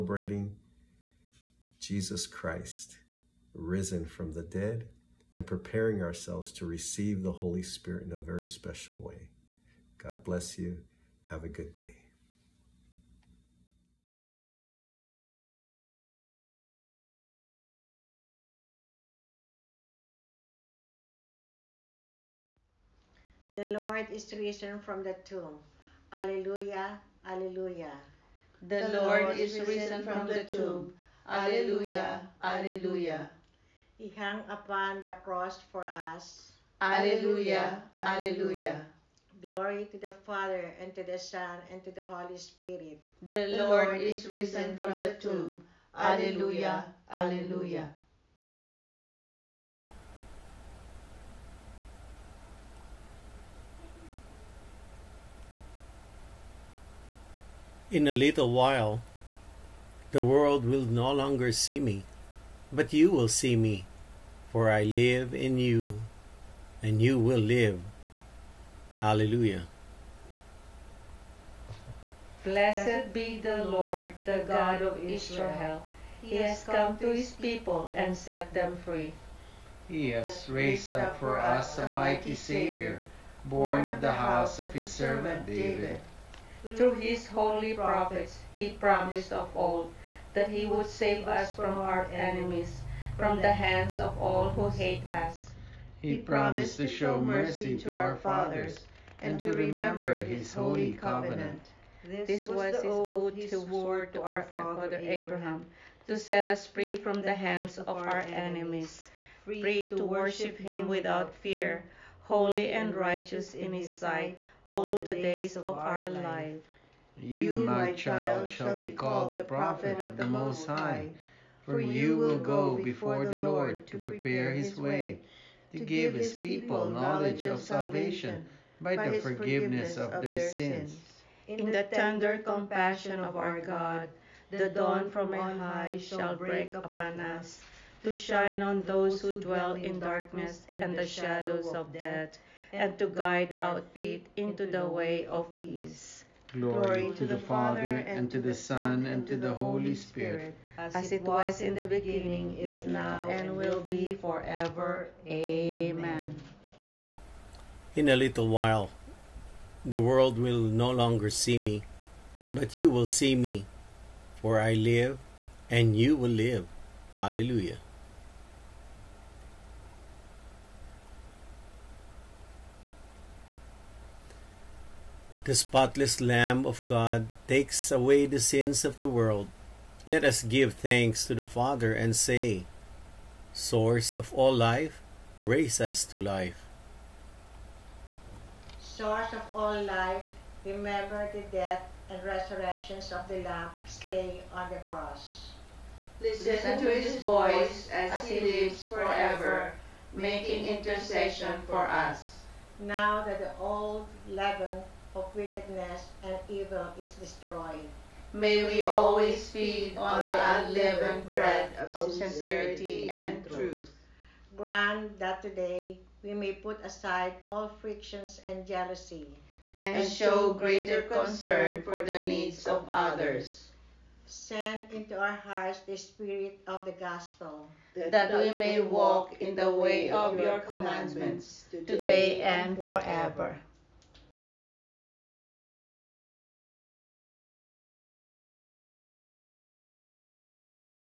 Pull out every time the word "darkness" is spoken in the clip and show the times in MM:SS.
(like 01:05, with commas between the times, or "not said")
02:19.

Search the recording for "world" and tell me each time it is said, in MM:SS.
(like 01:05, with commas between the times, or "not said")
01:00, 02:40, 02:59.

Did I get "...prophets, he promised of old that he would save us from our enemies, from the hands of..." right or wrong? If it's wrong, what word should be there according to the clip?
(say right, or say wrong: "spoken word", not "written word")
right.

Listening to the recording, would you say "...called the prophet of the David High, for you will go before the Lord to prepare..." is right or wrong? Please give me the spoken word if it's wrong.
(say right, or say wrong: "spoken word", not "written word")
wrong: "Most", not "David".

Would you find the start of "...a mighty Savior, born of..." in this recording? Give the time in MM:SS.
01:21.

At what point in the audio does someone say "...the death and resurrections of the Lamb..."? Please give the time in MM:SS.
03:11.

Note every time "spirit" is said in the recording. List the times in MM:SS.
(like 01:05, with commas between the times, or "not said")
00:07, 00:42, 02:29, 03:45.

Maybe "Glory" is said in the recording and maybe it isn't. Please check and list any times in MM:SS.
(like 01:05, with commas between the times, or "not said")
00:39, 02:26.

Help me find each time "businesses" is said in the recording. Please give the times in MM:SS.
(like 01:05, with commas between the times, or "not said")
not said.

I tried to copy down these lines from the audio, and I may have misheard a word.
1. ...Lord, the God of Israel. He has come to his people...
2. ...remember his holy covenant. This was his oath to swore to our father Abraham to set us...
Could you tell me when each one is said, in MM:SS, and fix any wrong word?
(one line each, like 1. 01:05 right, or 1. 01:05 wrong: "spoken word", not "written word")
1. 01:13 right
2. 01:39 right.